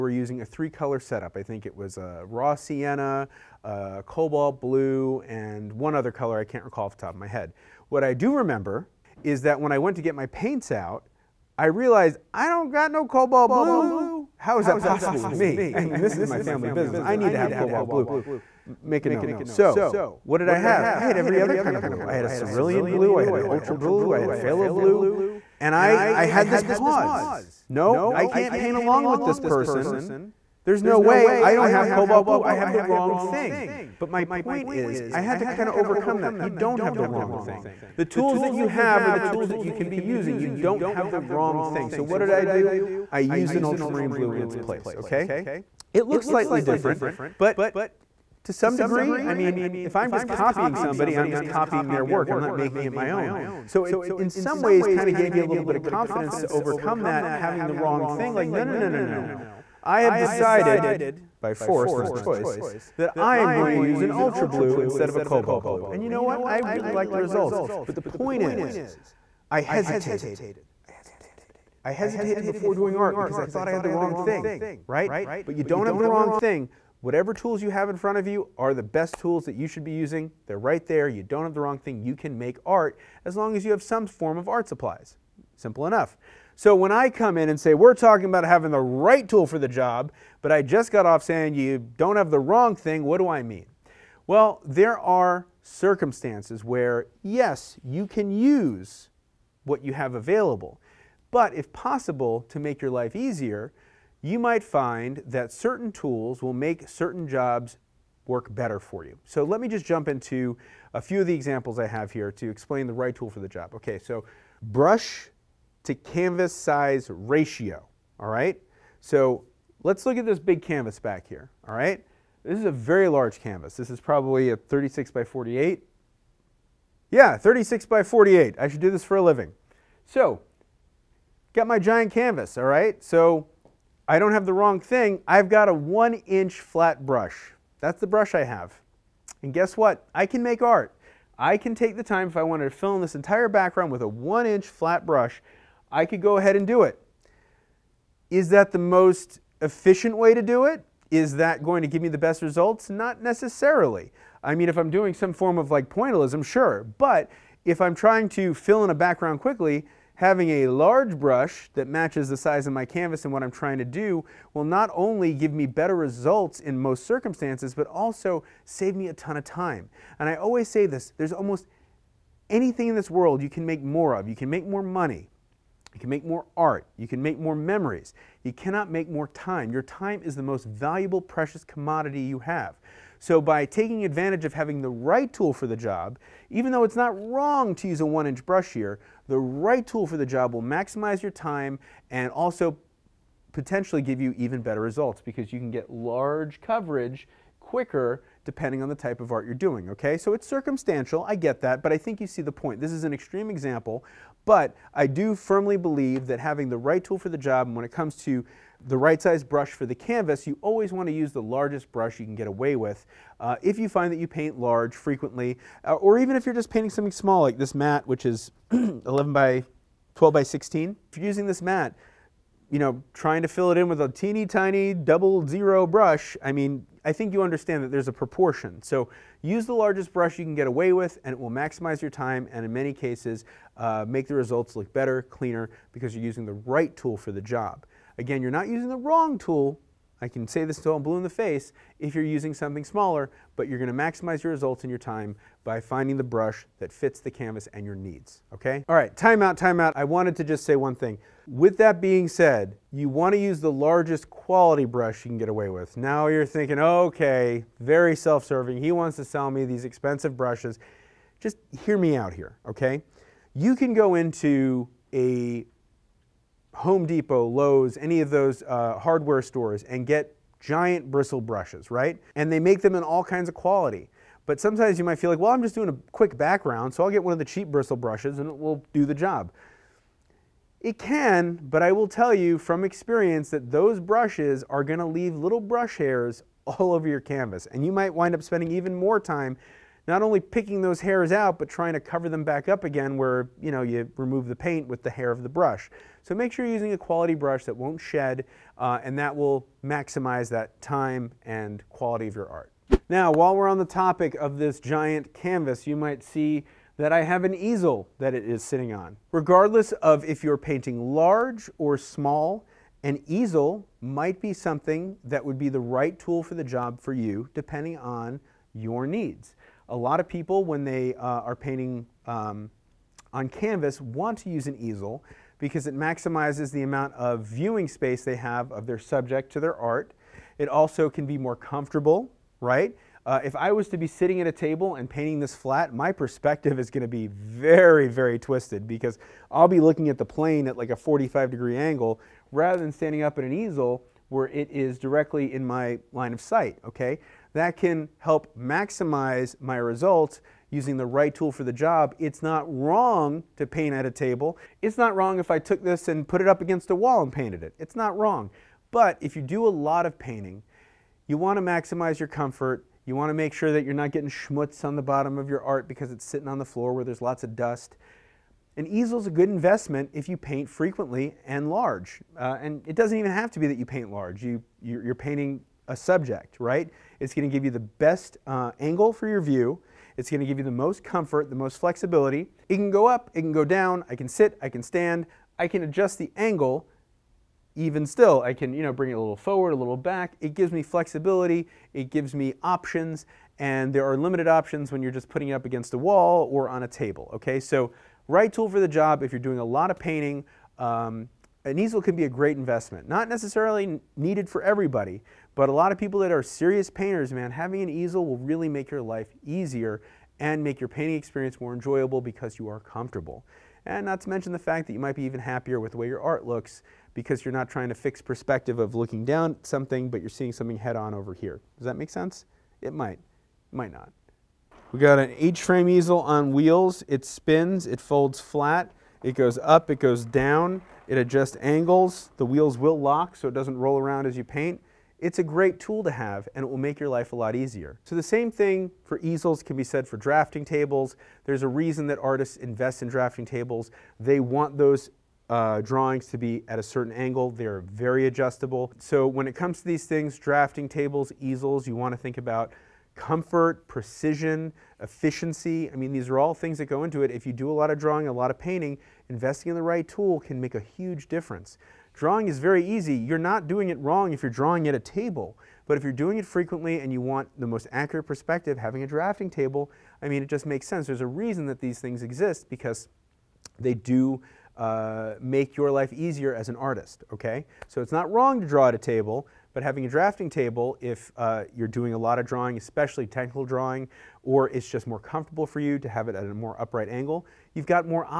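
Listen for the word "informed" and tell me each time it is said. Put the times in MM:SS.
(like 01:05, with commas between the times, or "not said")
not said.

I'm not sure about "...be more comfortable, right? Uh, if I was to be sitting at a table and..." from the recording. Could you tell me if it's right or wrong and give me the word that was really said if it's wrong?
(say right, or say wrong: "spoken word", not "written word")
right.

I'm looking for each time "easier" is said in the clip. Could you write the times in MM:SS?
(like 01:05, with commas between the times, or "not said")
01:43, 06:49, 07:17, 07:56.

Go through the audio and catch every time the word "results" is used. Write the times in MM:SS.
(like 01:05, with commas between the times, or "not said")
01:07, 02:32, 02:45, 03:14, 03:54, 04:04, 05:49.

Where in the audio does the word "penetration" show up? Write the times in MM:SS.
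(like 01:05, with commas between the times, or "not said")
not said.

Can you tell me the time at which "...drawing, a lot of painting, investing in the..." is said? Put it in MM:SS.
07:37.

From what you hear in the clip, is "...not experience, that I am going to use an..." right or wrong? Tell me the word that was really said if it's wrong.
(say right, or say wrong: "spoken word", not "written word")
wrong: "choice", not "experience".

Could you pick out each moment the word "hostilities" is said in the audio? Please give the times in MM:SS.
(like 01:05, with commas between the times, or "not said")
not said.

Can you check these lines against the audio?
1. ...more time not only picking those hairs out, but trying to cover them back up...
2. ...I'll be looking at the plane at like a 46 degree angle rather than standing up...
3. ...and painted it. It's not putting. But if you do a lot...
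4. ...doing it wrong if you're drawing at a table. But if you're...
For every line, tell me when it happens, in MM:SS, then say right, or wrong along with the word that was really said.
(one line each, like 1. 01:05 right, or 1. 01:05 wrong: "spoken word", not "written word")
1. 04:48 right
2. 05:39 wrong: "45", not "46"
3. 05:57 wrong: "wrong", not "putting"
4. 07:43 right.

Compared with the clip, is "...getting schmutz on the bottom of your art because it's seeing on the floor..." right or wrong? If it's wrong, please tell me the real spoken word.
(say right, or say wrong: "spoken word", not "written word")
wrong: "sitting", not "seeing".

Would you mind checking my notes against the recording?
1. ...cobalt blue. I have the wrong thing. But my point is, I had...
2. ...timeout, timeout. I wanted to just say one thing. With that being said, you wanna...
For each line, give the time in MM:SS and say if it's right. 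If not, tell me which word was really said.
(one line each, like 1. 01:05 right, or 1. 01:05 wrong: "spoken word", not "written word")
1. 00:31 right
2. 04:09 right.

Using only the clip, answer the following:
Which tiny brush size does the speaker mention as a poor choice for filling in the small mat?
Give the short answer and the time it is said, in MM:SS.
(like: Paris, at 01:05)
Double zero, at 03:44.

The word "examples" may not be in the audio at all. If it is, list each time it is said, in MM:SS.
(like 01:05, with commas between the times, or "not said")
01:51, 03:23.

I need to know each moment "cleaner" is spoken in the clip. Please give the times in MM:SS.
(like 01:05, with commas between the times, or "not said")
03:55.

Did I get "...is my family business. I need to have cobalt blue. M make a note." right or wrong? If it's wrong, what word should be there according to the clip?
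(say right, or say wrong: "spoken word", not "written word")
right.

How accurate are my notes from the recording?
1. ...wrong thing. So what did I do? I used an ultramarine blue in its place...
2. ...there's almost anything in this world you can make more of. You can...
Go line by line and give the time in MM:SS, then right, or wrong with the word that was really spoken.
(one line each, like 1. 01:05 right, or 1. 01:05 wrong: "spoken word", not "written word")
1. 00:41 right
2. 02:51 right.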